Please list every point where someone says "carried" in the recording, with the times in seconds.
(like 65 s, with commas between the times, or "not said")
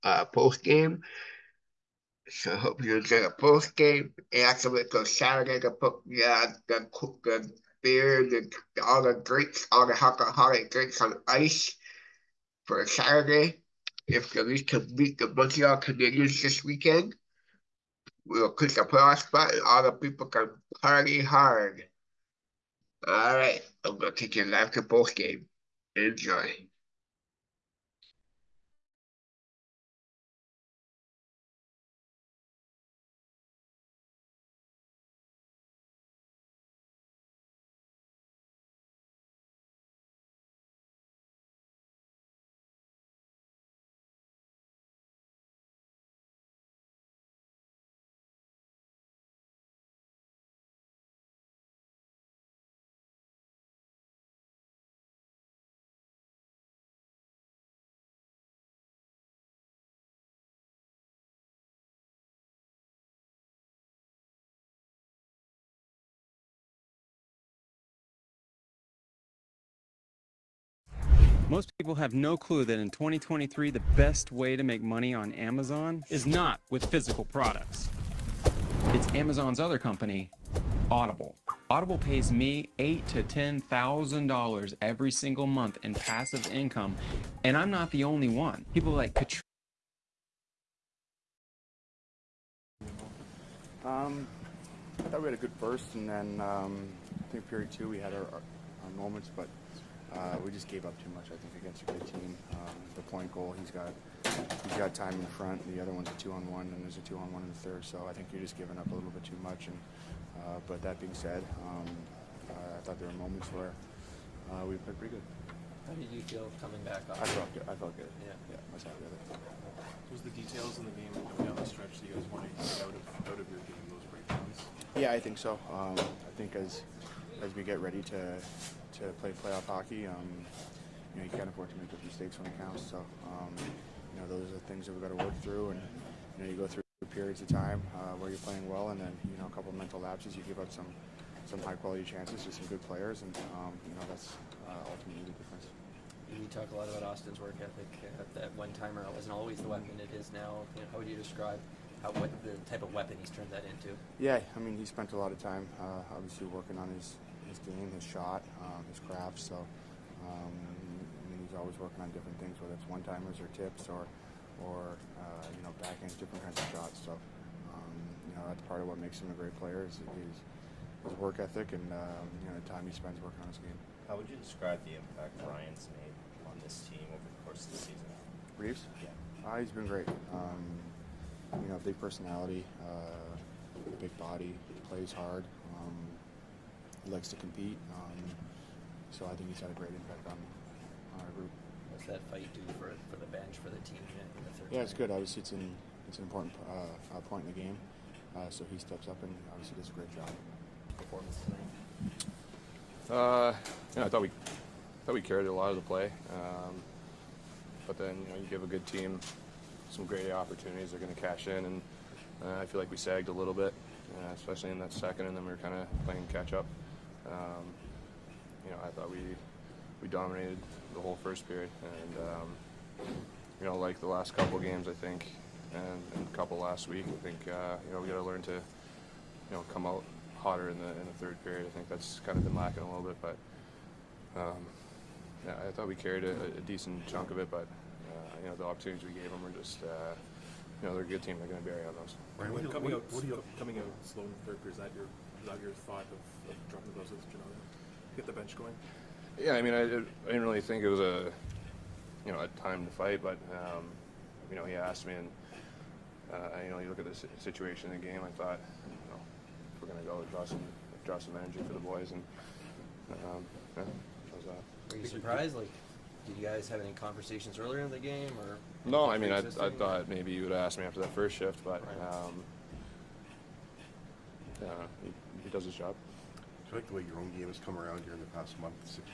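205 s, 235 s.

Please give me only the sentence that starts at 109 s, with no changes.
And uh, but that being said, um, uh, I thought there were moments where uh, we played pretty good.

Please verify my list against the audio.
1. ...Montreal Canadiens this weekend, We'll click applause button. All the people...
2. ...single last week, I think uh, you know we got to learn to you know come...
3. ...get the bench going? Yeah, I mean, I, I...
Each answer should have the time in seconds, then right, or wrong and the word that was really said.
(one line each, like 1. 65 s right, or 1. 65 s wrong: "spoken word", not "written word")
1. 15 s right
2. 226 s wrong: "couple", not "single"
3. 248 s right.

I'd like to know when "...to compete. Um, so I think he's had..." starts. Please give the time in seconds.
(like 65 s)
187 s.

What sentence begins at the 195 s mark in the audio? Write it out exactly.
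Obviously, it's an, it's an important uh, uh, point in the game.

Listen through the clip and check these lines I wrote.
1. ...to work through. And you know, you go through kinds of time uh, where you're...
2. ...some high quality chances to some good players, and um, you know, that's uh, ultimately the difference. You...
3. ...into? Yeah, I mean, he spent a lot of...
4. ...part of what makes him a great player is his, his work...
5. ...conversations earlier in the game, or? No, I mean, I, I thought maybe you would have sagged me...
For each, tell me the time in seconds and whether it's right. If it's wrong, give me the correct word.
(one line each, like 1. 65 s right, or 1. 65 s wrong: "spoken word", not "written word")
1. 135 s wrong: "periods", not "kinds"
2. 141 s right
3. 153 s right
4. 168 s right
5. 266 s wrong: "asked", not "sagged".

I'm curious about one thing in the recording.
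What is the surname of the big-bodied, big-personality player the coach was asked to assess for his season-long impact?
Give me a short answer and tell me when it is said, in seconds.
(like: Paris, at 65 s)
Reaves, at 178 s.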